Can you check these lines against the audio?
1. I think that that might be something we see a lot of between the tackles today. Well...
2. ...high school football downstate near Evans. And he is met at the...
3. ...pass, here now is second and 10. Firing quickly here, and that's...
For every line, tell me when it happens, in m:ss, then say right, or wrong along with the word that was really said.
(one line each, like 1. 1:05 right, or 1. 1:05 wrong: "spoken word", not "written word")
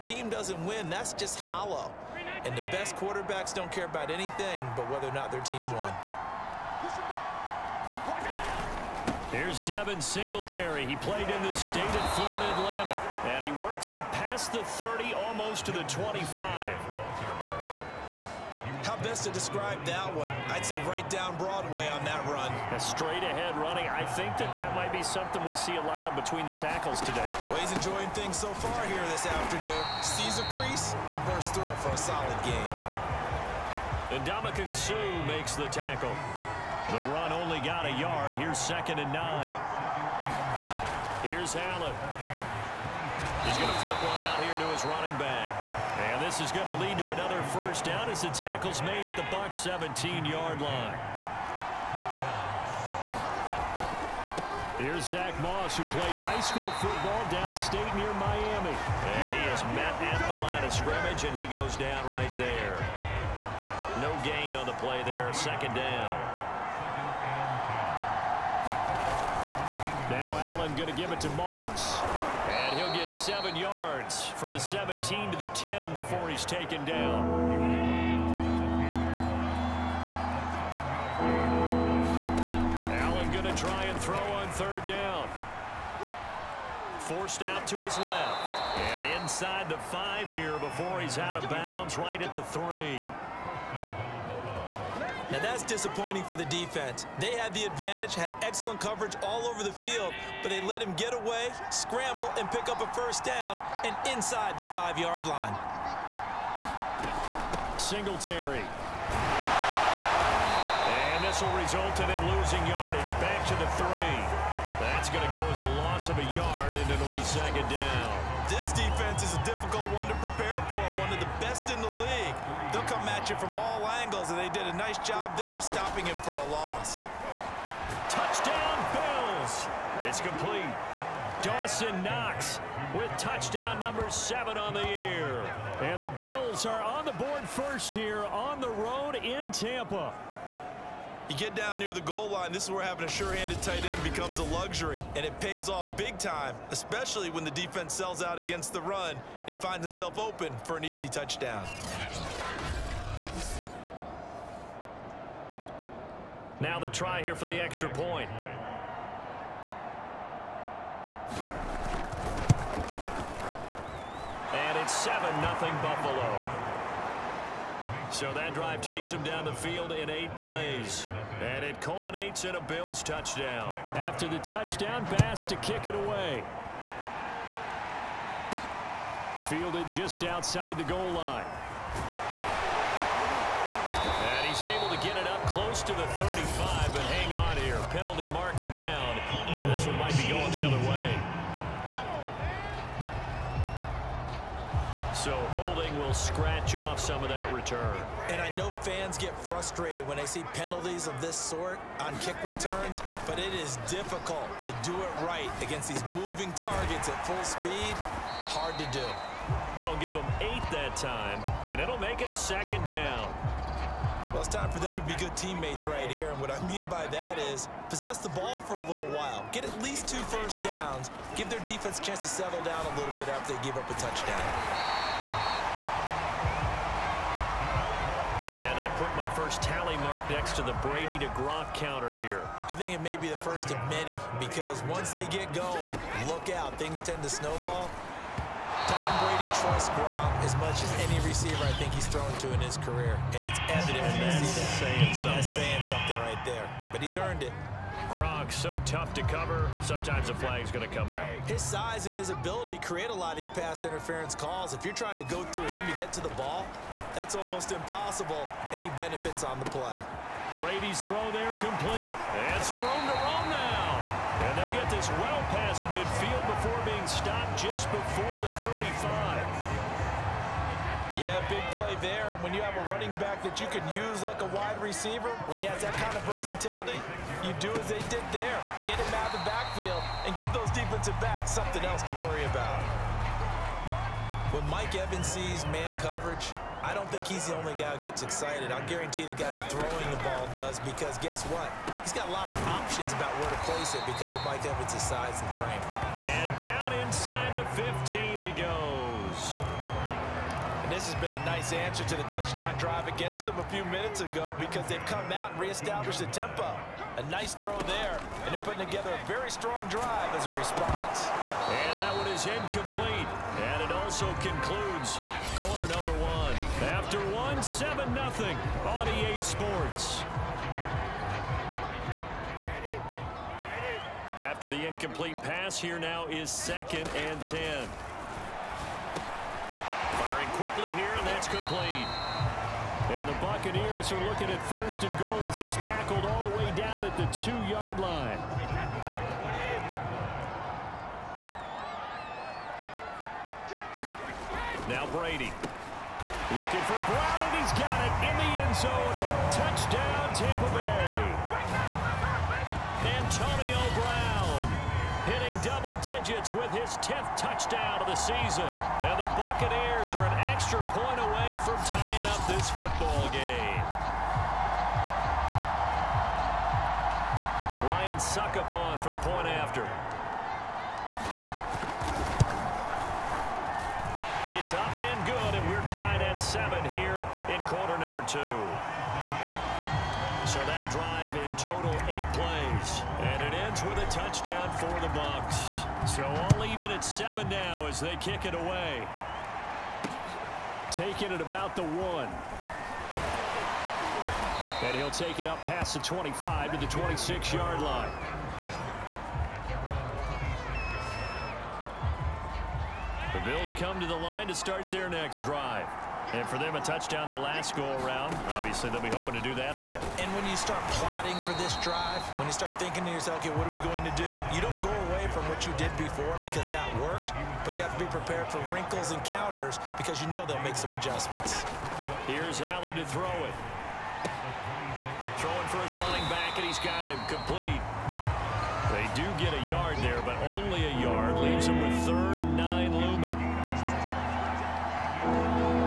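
1. 0:23 right
2. 0:56 wrong: "Miami", not "Evans"
3. 5:25 right.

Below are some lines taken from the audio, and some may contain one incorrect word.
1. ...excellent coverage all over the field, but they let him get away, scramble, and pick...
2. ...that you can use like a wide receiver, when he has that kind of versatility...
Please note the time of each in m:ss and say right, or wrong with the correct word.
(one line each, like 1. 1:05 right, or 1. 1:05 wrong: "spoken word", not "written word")
1. 1:38 right
2. 4:33 right.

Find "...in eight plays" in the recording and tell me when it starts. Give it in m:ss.
2:49.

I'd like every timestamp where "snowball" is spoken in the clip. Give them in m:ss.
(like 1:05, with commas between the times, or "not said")
3:57.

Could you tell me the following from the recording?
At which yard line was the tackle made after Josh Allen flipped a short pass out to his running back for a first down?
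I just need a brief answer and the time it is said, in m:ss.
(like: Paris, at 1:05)
17, at 0:49.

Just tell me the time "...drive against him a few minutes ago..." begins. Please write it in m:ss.
5:02.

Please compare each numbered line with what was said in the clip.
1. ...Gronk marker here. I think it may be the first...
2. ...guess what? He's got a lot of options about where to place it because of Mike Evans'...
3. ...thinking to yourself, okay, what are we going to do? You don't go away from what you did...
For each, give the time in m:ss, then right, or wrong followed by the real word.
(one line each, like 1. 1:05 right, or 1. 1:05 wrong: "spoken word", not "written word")
1. 3:51 wrong: "counter", not "marker"
2. 4:51 right
3. 6:52 right.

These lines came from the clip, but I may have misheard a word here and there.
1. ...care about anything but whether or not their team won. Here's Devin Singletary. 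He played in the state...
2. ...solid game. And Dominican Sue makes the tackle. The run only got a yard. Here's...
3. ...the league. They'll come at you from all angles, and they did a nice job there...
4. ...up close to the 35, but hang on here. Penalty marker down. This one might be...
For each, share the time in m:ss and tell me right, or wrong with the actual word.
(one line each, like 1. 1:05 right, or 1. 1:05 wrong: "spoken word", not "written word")
1. 0:03 right
2. 0:31 right
3. 2:01 right
4. 3:05 right.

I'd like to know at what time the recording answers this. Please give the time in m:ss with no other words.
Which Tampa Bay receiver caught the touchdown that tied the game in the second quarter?
5:53.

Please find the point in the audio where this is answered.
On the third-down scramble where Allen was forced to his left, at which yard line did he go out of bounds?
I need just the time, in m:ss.
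1:31.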